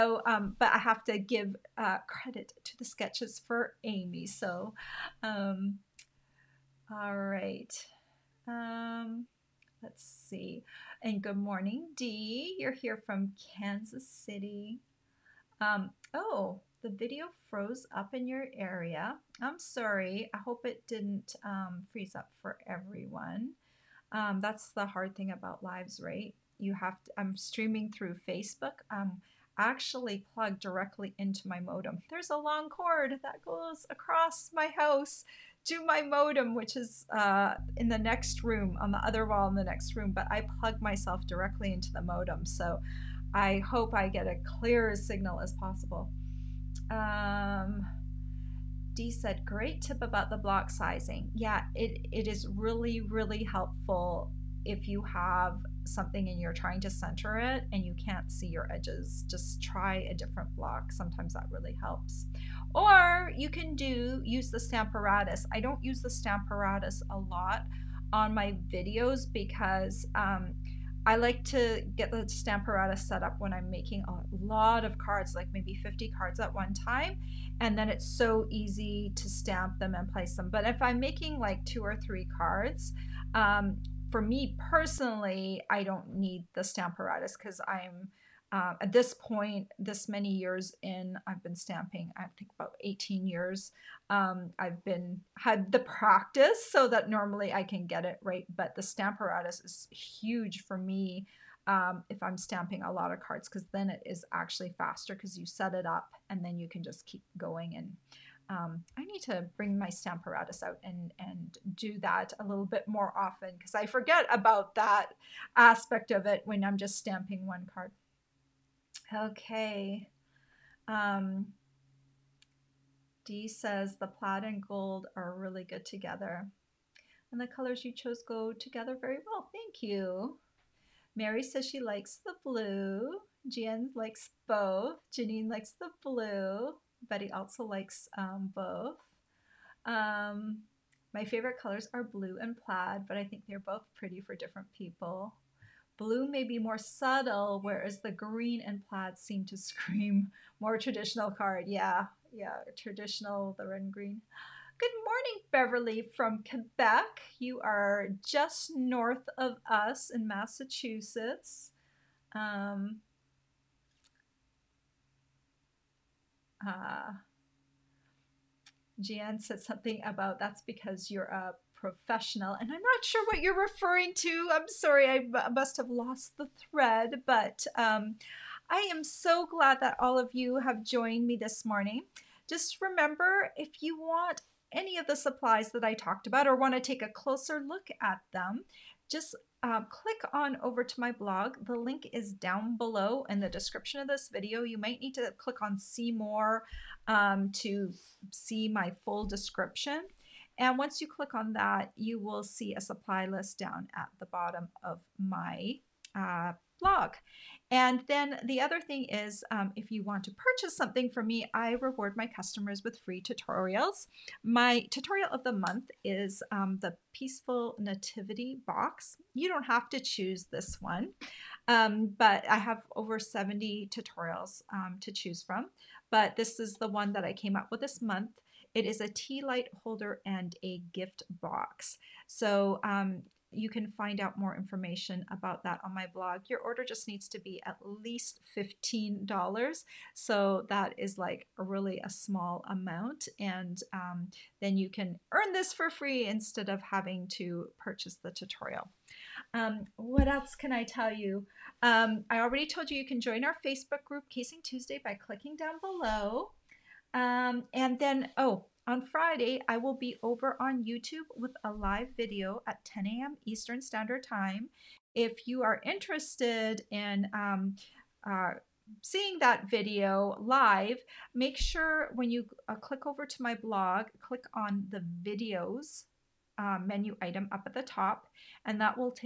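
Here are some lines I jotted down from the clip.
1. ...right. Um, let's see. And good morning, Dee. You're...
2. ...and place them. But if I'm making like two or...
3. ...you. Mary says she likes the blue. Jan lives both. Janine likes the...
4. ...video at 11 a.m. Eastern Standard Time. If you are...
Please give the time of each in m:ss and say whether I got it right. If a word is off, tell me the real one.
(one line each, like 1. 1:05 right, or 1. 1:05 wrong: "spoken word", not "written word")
1. 0:07 right
2. 1:19 right
3. 2:09 wrong: "likes", not "lives"
4. 4:22 wrong: "10", not "11".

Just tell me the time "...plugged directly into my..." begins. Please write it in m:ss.
0:30.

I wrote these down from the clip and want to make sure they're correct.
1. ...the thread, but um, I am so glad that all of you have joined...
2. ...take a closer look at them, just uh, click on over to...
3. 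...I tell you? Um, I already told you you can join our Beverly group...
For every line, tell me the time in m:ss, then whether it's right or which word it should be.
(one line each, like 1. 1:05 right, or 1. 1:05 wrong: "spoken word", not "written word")
1. 2:56 right
2. 3:06 right
3. 4:10 wrong: "Facebook", not "Beverly".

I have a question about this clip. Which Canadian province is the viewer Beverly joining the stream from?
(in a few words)
Quebec.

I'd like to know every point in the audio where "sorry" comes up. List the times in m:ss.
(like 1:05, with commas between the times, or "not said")
0:19, 2:54.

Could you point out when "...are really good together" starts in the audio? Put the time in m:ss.
2:05.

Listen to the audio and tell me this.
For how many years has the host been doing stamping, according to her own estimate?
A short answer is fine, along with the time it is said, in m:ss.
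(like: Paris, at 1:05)
18 years, at 1:32.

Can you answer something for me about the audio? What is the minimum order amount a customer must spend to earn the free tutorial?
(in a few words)
$15.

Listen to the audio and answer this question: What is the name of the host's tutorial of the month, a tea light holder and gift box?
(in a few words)
Peaceful Nativity box.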